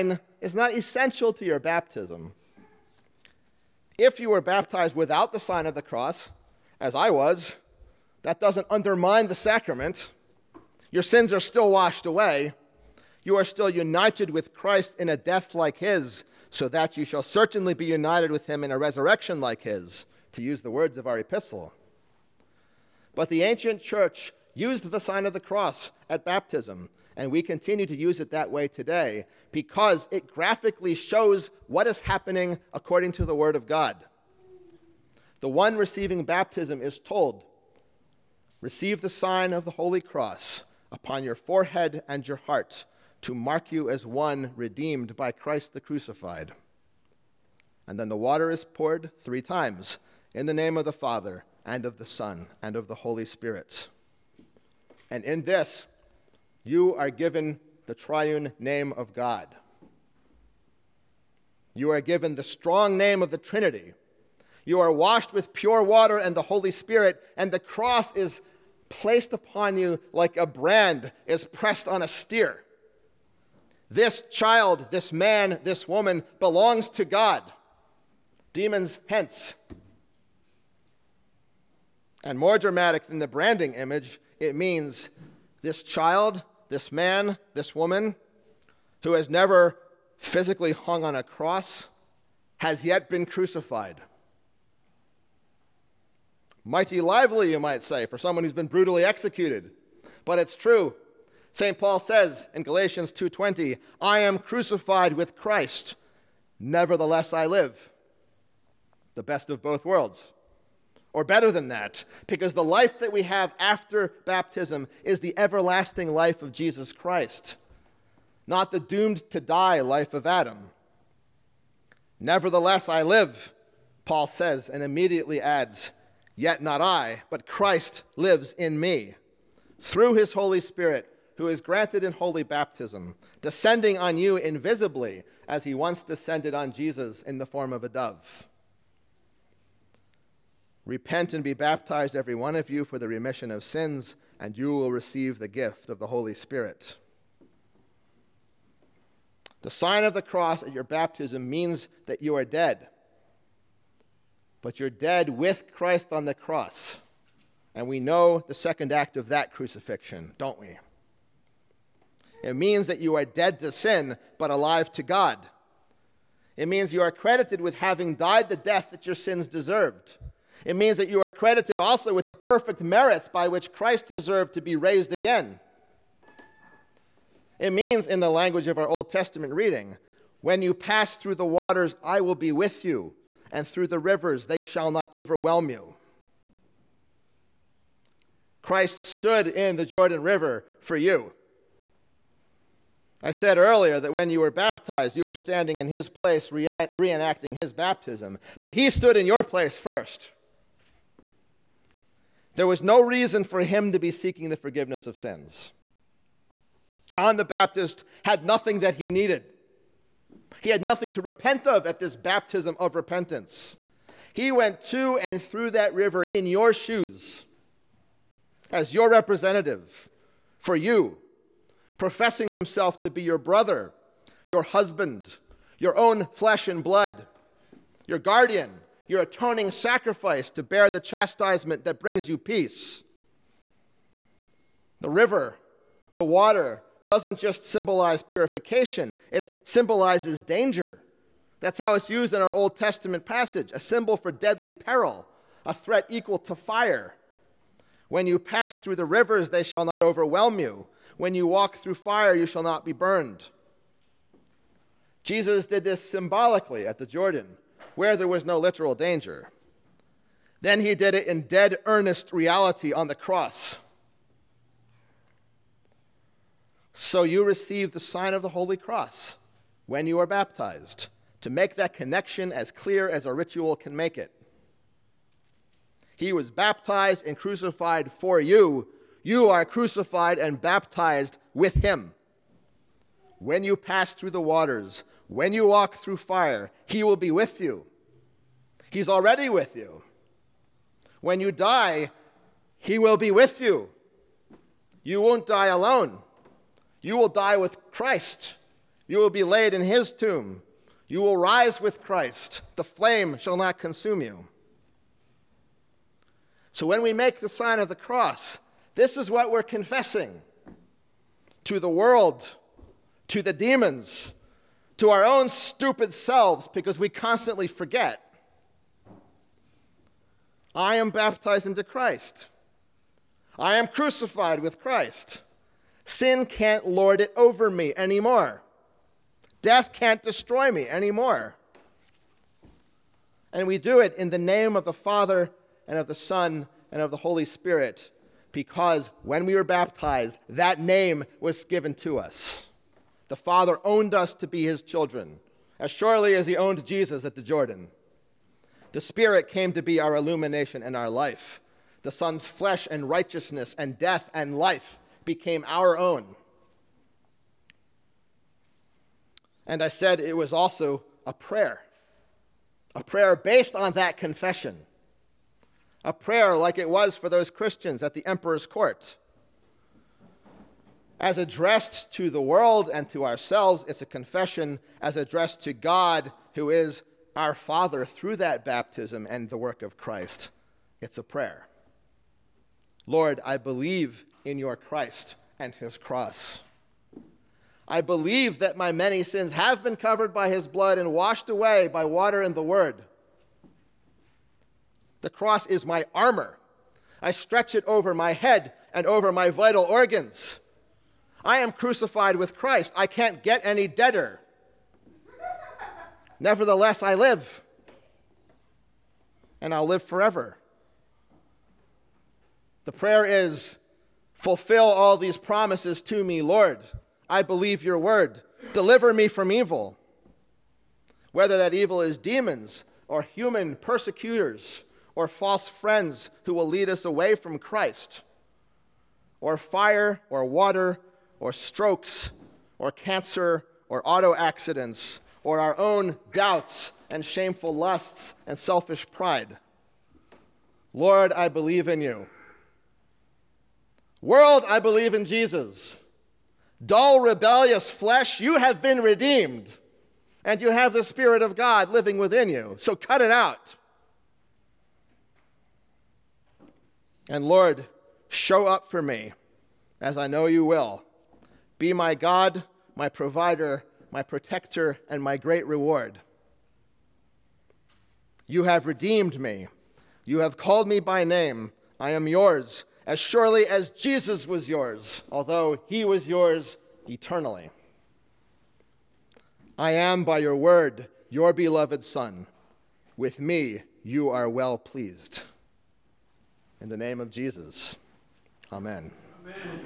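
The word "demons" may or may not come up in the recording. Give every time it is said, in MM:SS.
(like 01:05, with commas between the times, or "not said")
01:18, 05:13, 07:02.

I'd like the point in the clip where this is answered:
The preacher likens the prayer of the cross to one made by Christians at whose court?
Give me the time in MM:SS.
06:08.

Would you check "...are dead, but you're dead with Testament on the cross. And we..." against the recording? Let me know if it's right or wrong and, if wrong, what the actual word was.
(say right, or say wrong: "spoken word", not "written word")
wrong: "Christ", not "Testament".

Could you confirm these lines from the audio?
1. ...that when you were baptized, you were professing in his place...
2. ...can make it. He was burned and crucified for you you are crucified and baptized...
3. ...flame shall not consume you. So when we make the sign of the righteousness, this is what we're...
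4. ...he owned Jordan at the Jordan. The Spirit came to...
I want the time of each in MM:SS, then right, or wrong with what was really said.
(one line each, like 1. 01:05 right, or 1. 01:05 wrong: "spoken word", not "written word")
1. 03:13 wrong: "standing", not "professing"
2. 04:33 wrong: "baptized", not "burned"
3. 05:02 wrong: "cross", not "righteousness"
4. 05:46 wrong: "Jesus", not "Jordan".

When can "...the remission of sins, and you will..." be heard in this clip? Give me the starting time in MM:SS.
02:22.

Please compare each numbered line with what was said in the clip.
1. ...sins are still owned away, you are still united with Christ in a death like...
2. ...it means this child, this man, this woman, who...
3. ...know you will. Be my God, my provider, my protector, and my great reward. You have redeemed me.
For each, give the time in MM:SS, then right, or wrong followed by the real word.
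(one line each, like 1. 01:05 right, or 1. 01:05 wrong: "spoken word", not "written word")
1. 00:11 wrong: "washed", not "owned"
2. 01:24 right
3. 07:40 right.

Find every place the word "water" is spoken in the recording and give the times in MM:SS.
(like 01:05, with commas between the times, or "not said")
00:48, 01:05, 03:01, 03:56, 04:44, 06:32, 07:10.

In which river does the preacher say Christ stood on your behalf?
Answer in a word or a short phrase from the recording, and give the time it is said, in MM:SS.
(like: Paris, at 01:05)
Jordan River, at 03:09.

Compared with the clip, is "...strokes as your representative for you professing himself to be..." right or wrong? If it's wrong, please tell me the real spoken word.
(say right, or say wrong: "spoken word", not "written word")
wrong: "shoes", not "strokes".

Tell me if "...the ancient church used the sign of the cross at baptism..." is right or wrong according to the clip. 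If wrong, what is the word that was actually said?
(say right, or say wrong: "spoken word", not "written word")
right.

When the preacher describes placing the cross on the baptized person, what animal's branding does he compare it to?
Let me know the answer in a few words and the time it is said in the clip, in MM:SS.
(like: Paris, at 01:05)
A steer, at 01:12.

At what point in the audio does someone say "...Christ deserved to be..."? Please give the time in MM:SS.
02:53.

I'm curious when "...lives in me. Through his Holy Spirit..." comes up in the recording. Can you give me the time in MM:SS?
02:08.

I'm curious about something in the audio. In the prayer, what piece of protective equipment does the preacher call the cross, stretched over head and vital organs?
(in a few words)
Armor.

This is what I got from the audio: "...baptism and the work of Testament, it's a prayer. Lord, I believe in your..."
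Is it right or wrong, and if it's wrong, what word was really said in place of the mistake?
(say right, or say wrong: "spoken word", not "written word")
wrong: "Christ", not "Testament".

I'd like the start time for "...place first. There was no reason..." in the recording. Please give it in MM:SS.
03:19.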